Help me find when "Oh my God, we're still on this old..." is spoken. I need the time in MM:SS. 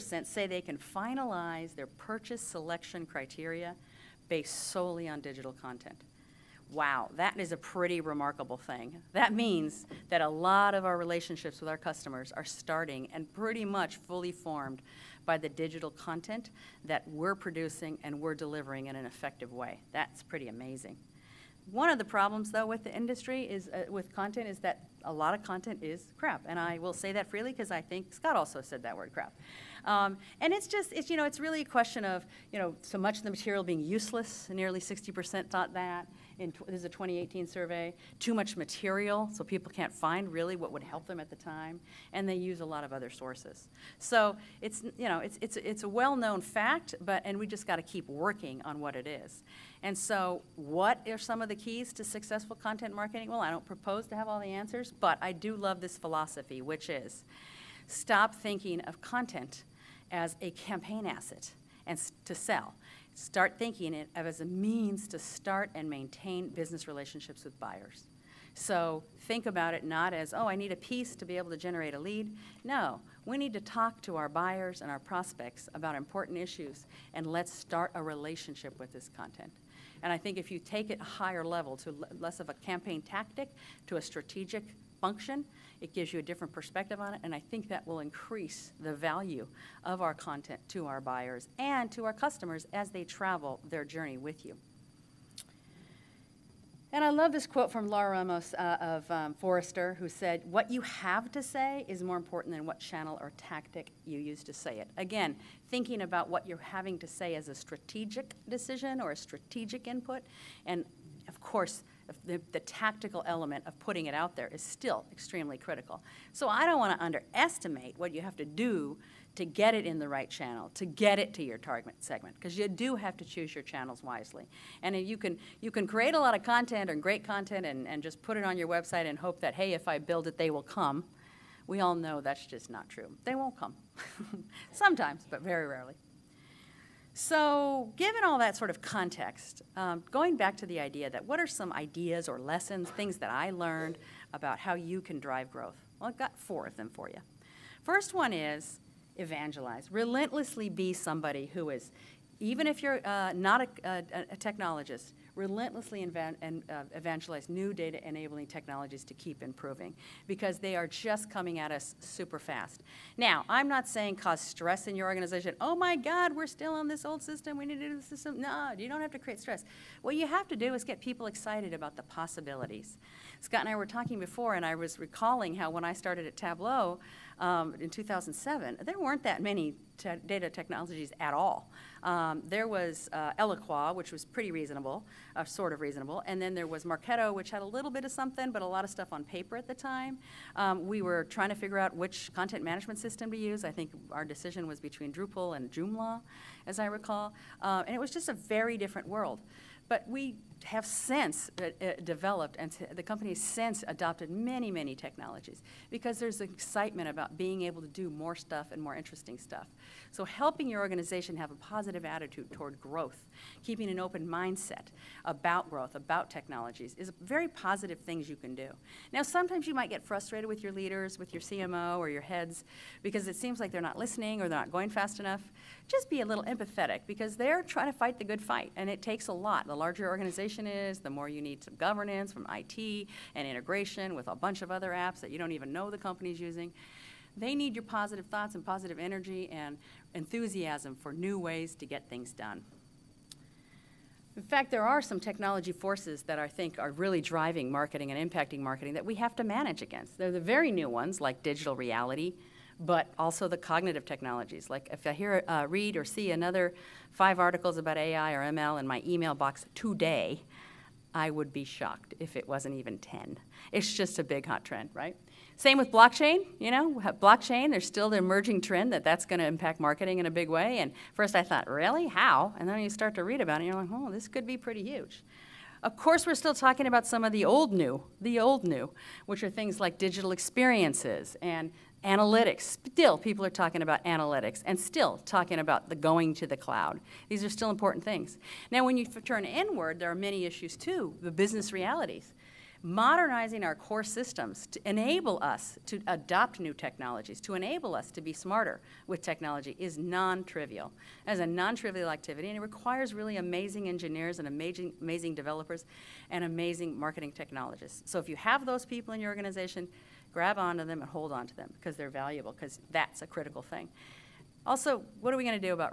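02:45.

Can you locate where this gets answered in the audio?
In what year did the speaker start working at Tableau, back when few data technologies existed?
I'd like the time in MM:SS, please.
02:57.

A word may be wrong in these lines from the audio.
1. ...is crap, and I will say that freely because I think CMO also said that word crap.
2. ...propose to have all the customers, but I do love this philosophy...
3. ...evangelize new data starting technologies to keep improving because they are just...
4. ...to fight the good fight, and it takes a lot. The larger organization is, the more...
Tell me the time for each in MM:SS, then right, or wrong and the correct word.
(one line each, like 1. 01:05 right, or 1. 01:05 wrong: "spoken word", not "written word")
1. 00:25 wrong: "Scott", not "CMO"
2. 00:53 wrong: "answers", not "customers"
3. 02:36 wrong: "enabling", not "starting"
4. 03:47 right.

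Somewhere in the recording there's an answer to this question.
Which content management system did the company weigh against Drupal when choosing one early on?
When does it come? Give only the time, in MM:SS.
03:15.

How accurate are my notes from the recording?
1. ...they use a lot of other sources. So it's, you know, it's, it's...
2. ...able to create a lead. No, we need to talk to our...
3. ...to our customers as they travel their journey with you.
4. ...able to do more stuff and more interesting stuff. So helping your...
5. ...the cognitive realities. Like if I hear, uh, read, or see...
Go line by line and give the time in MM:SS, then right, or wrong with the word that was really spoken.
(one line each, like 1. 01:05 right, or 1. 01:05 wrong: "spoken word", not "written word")
1. 00:42 right
2. 01:11 wrong: "generate", not "create"
3. 01:31 right
4. 03:27 right
5. 04:13 wrong: "technologies", not "realities".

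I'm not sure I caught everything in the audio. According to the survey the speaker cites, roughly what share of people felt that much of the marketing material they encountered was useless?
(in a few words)
60%.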